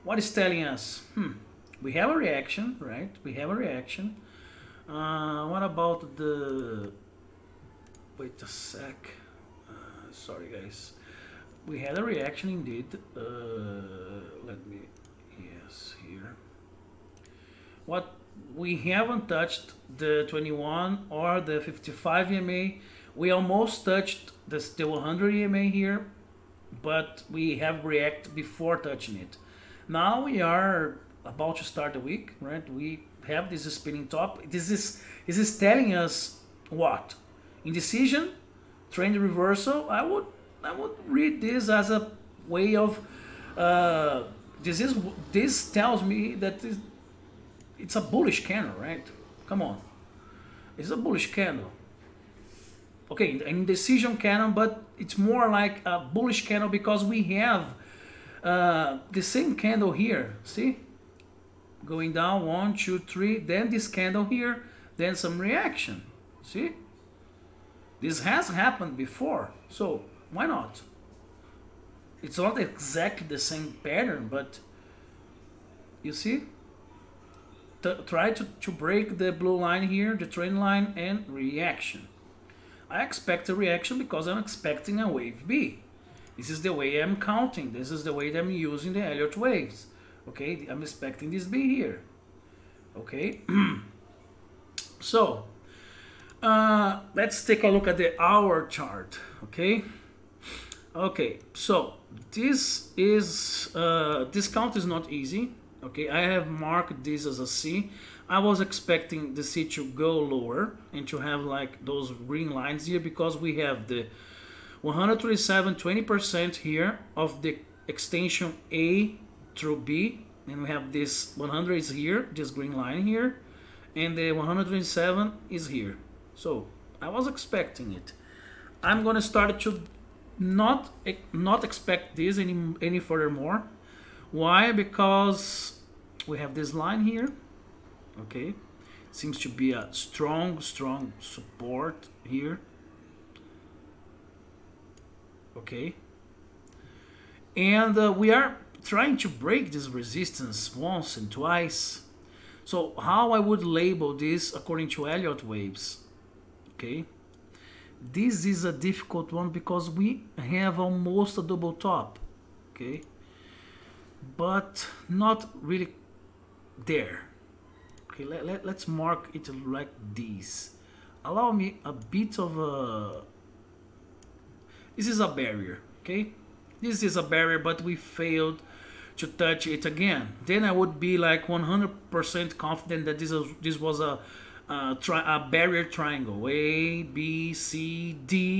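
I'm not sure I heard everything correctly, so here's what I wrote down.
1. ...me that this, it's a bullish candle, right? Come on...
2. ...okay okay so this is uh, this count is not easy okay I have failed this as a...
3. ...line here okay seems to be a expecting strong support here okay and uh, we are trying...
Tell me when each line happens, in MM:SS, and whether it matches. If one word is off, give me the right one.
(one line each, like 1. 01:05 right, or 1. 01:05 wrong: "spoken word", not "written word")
1. 00:46 right
2. 01:39 wrong: "marked", not "failed"
3. 02:16 wrong: "strong", not "expecting".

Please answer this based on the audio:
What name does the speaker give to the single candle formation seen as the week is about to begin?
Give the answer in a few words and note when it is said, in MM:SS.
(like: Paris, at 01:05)
spinning top, at 00:33.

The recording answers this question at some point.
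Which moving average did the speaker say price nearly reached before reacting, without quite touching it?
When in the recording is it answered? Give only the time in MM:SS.
00:24.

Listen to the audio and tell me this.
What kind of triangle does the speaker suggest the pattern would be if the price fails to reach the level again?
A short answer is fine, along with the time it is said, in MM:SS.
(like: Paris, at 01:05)
barrier triangle, at 03:05.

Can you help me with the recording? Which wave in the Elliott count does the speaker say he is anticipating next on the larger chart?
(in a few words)
wave B.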